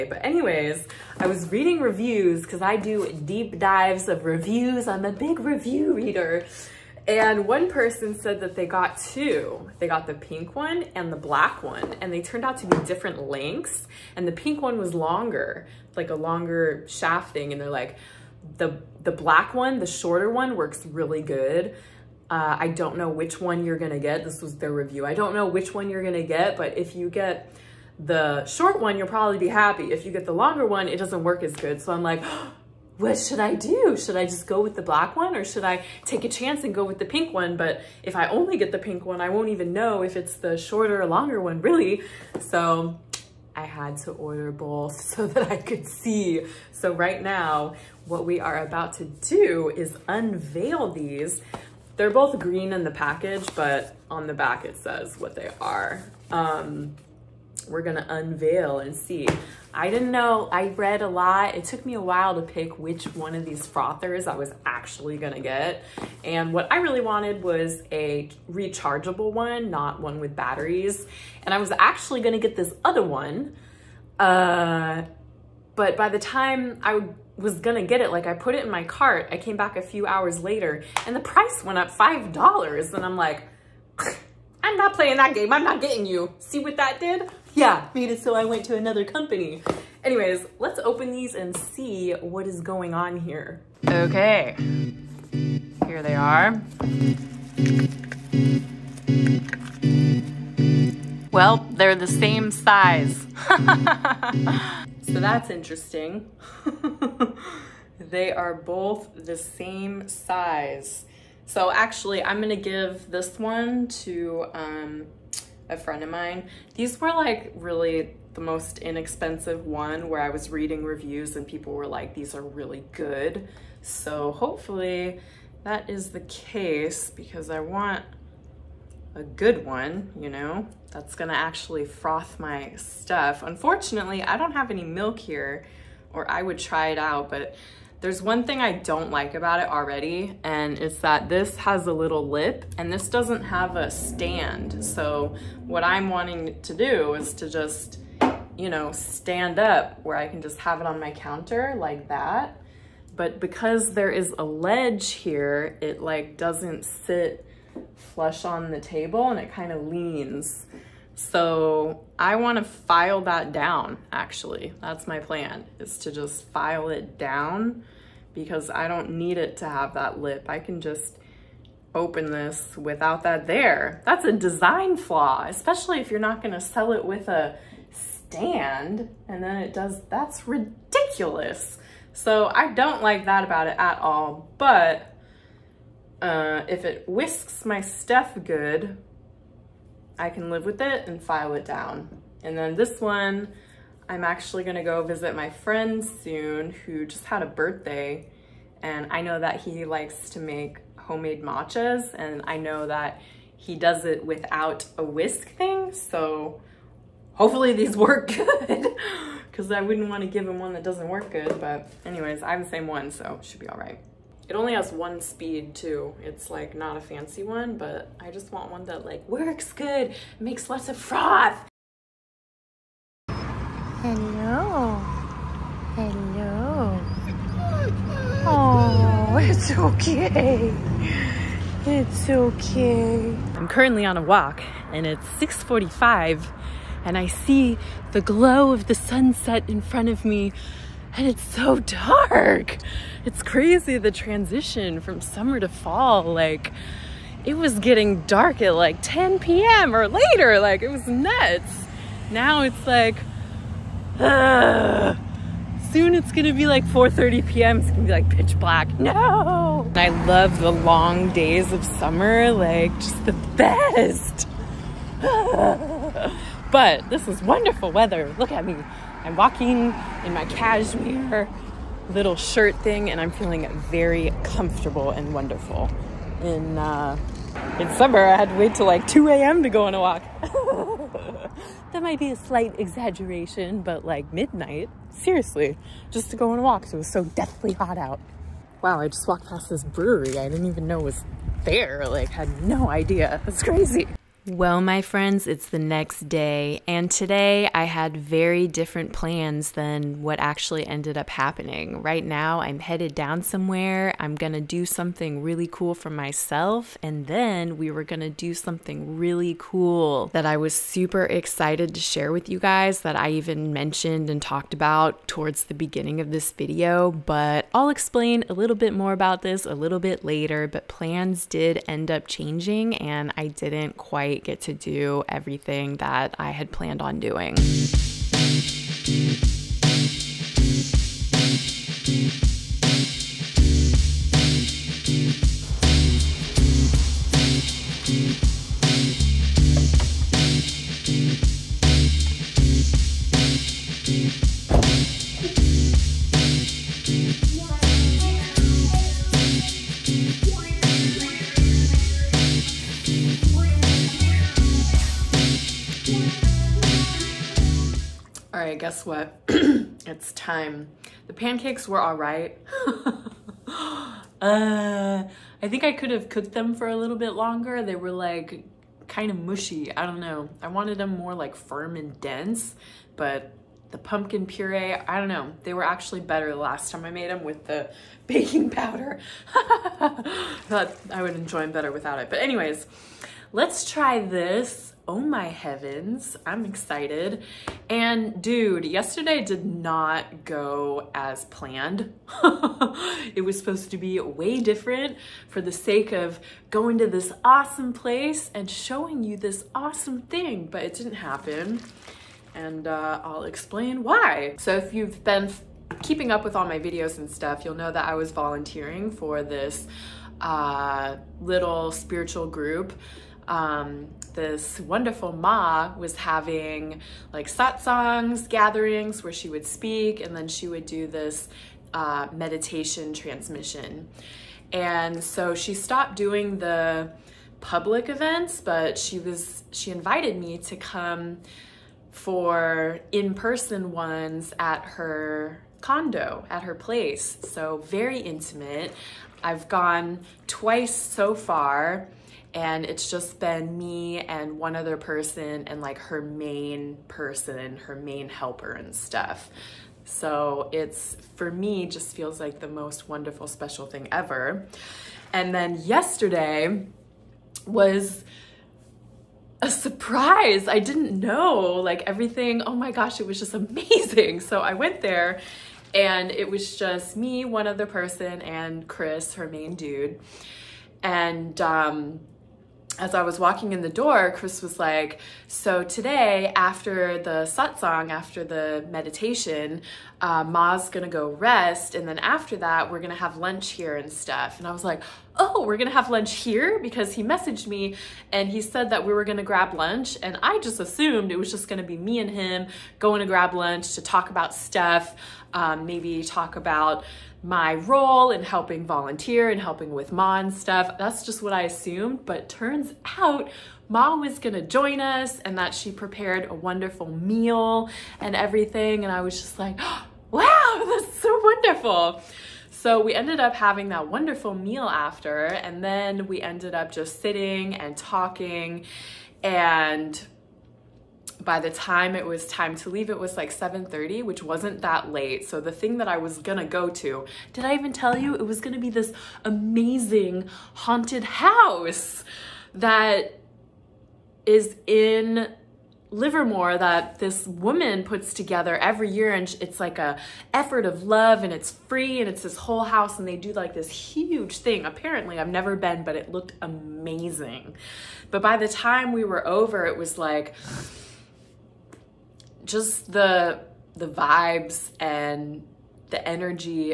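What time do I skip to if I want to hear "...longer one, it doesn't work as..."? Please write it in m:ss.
0:30.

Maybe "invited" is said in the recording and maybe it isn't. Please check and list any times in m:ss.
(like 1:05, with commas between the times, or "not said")
7:09.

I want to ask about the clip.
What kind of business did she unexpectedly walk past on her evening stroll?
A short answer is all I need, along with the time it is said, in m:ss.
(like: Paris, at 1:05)
brewery, at 4:49.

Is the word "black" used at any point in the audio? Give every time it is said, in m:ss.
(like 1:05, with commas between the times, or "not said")
0:11, 0:19, 0:34, 4:18.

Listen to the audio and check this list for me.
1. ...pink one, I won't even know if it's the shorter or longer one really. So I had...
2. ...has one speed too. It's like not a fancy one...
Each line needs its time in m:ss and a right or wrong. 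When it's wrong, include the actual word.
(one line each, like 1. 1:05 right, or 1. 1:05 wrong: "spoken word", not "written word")
1. 0:38 right
2. 3:34 right.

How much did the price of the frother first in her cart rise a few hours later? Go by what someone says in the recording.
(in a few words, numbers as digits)
$5.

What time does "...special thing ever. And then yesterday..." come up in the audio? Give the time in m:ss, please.
7:33.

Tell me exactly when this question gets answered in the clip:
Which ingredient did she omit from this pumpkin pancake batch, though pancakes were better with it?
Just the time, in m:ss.
6:18.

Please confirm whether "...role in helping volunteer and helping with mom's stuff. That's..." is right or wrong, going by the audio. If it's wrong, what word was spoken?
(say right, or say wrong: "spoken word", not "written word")
right.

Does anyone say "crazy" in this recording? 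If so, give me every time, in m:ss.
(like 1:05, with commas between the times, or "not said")
4:03, 4:53.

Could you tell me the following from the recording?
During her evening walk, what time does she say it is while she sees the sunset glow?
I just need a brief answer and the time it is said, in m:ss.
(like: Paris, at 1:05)
6:45, at 3:55.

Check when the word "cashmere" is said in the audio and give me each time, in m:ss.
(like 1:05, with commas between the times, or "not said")
4:30.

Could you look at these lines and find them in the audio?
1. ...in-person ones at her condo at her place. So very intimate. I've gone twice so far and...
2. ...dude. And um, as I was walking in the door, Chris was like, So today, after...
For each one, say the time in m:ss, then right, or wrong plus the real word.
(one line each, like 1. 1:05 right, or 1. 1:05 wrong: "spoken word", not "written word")
1. 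7:13 right
2. 7:49 right.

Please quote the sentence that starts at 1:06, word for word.
And what I really wanted was a rechargeable one, not one with batteries.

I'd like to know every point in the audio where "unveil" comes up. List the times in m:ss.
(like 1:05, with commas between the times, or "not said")
0:50, 0:58.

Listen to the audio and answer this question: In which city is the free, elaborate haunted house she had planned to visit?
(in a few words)
Livermore.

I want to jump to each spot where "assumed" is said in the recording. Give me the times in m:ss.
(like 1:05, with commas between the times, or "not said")
8:10, 8:21.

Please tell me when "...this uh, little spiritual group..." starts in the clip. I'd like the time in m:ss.
6:49.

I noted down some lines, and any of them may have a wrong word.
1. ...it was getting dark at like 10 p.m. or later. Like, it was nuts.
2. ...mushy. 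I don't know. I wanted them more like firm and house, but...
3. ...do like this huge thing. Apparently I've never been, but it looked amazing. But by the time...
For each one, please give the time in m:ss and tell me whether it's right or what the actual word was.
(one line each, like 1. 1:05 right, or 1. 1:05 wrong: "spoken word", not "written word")
1. 4:07 right
2. 6:09 wrong: "dense", not "house"
3. 9:03 right.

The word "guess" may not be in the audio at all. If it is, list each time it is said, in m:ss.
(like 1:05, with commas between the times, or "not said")
5:58.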